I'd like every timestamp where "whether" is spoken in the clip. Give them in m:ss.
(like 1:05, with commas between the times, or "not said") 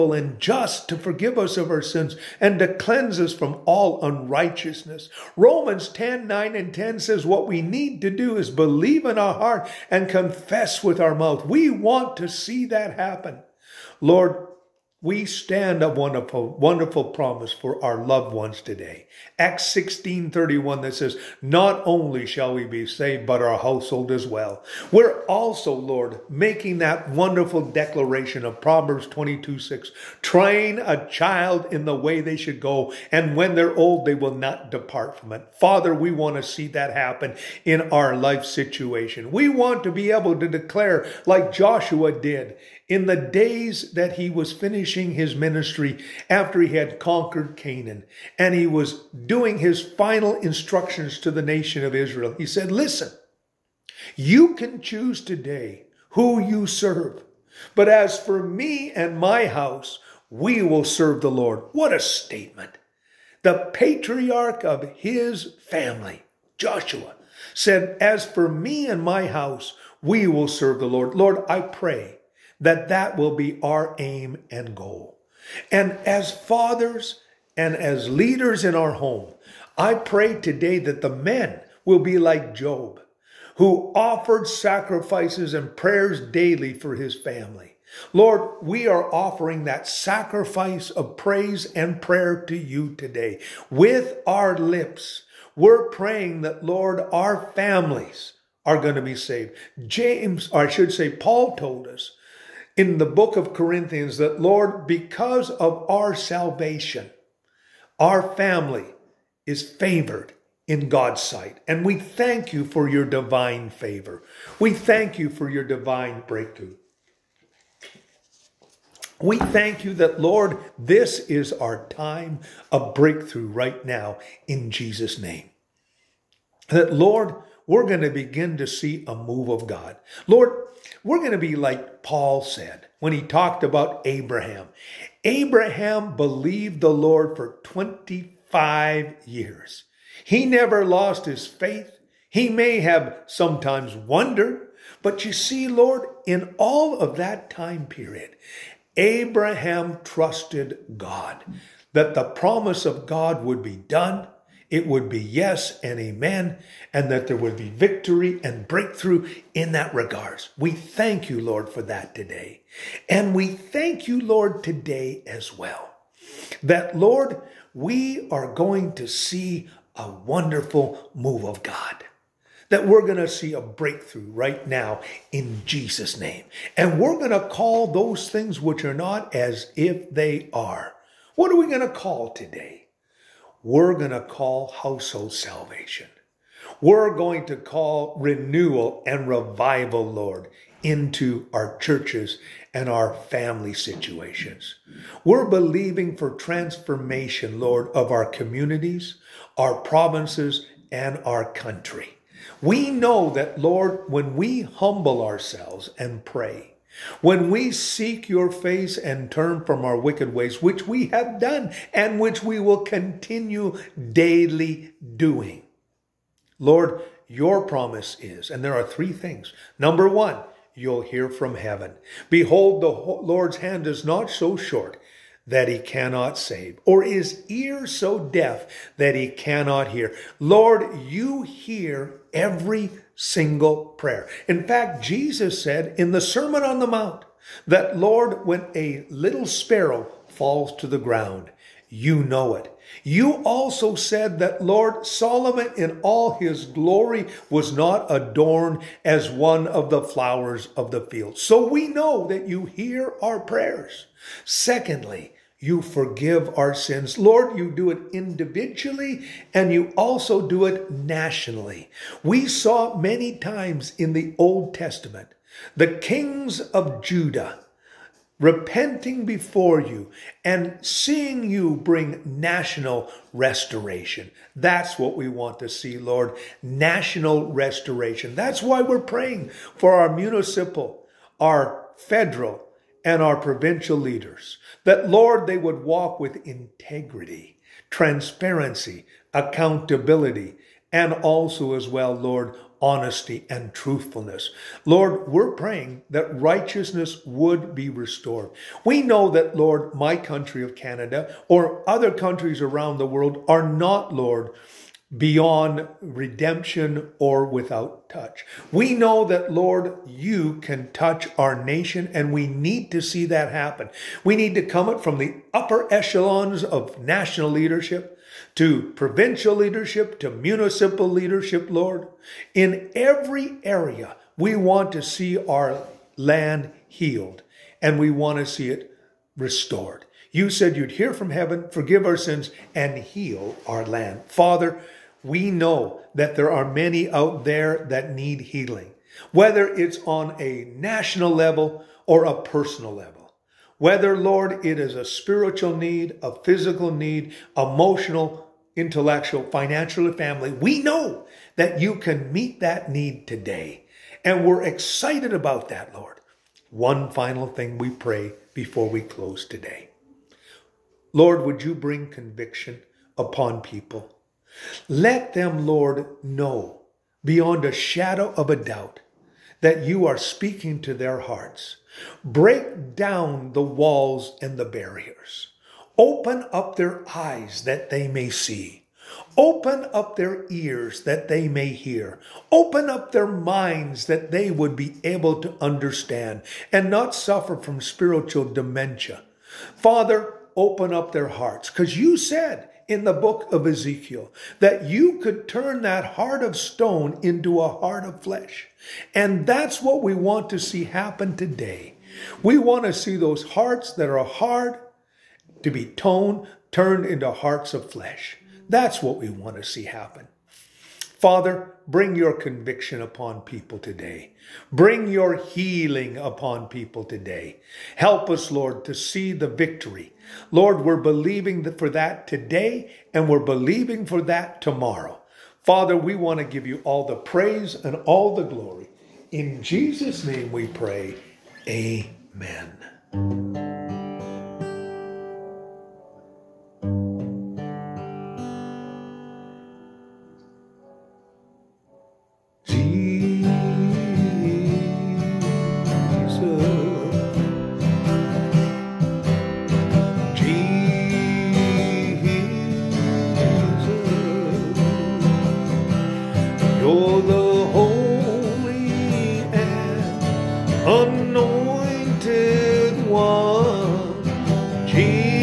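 5:39, 5:43.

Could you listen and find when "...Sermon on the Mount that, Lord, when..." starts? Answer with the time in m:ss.
3:56.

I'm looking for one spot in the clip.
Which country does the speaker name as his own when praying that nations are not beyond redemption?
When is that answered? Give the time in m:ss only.
5:00.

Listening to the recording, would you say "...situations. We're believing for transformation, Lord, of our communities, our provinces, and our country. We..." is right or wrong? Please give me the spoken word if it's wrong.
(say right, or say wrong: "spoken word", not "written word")
right.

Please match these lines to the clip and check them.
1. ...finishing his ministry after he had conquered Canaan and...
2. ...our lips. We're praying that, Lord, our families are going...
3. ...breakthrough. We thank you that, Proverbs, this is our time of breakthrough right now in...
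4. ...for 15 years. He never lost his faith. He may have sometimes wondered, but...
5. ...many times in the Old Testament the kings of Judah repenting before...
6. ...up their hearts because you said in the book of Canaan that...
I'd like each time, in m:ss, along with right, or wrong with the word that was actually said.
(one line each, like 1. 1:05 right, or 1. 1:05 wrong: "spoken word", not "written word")
1. 0:44 right
2. 1:34 right
3. 1:56 wrong: "Lord", not "Proverbs"
4. 2:17 wrong: "25", not "15"
5. 4:22 right
6. 6:30 wrong: "Ezekiel", not "Canaan".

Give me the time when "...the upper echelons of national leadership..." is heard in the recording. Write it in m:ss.
5:15.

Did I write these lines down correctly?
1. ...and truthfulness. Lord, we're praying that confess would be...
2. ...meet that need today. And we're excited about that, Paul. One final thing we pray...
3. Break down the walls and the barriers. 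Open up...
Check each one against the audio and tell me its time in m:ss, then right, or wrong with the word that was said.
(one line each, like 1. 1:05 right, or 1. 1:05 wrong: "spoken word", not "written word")
1. 4:53 wrong: "righteousness", not "confess"
2. 5:52 wrong: "Lord", not "Paul"
3. 6:12 right.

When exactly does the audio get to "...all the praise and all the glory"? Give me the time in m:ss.
7:06.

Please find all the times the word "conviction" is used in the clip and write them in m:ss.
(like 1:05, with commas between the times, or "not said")
6:02, 6:52.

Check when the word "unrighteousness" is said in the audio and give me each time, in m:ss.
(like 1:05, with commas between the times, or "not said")
0:04.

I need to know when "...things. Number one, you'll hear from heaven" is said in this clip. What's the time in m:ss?
3:39.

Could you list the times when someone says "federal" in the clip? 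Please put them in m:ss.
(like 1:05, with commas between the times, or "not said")
4:41.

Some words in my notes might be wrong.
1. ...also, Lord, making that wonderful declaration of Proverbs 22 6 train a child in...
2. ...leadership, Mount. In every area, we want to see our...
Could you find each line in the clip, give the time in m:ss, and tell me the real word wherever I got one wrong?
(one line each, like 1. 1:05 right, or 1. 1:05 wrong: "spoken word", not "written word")
1. 0:25 right
2. 5:21 wrong: "Lord", not "Mount".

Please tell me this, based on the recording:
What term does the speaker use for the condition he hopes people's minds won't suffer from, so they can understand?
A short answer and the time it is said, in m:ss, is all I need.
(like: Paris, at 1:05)
spiritual dementia, at 6:27.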